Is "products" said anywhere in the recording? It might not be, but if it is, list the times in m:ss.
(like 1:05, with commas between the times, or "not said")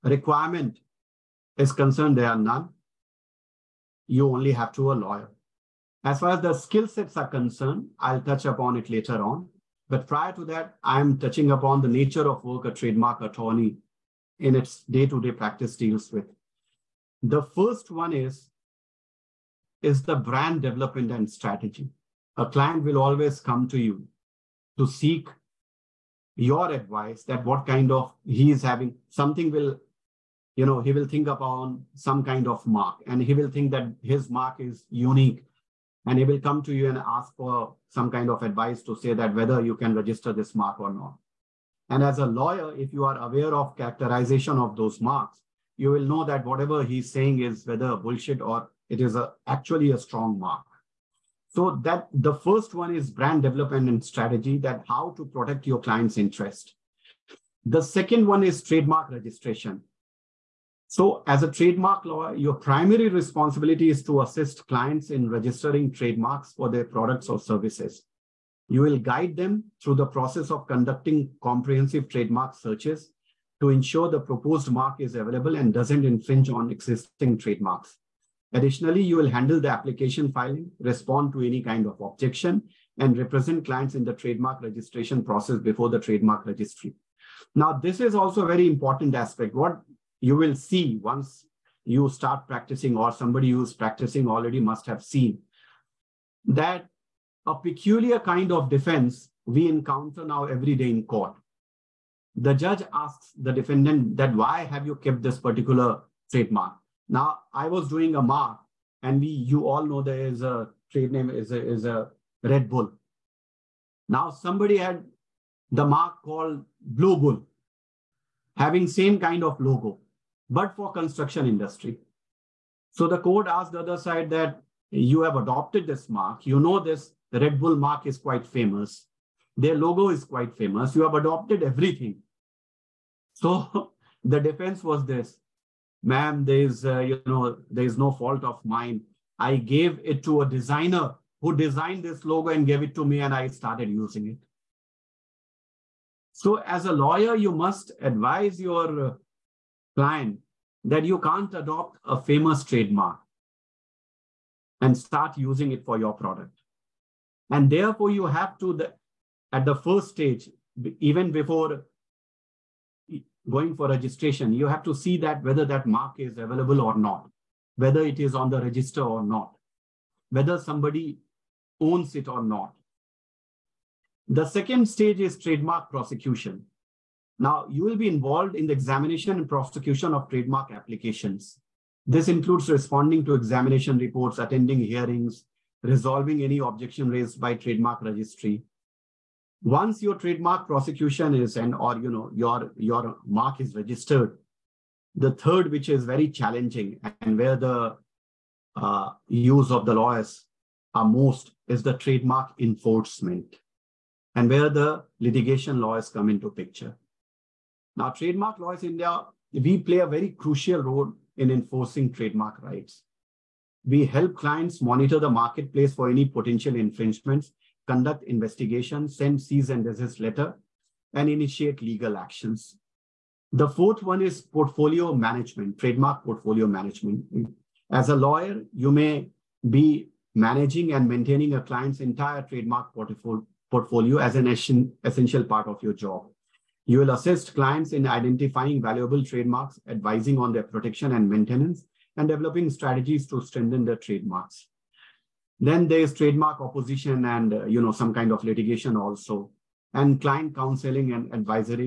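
1:06, 2:36.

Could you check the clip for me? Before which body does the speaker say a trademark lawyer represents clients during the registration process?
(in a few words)
the trademark registry.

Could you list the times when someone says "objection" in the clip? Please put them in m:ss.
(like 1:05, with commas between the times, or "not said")
1:21, 3:06.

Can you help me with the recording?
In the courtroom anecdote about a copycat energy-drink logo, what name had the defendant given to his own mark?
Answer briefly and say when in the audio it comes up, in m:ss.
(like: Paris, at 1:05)
Blue Bull, at 1:56.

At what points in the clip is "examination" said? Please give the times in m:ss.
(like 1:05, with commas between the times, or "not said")
2:58, 3:03.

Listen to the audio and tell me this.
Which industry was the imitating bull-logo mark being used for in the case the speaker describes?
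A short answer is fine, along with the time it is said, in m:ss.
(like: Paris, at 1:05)
construction industry, at 2:00.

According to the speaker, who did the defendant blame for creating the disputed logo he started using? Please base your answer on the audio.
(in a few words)
a designer.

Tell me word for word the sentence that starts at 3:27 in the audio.
Now, trademark laws in India, we play a very crucial role in enforcing trademark rights.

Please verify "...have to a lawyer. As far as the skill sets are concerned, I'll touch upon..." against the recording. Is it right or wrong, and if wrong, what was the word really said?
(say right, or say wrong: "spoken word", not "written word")
right.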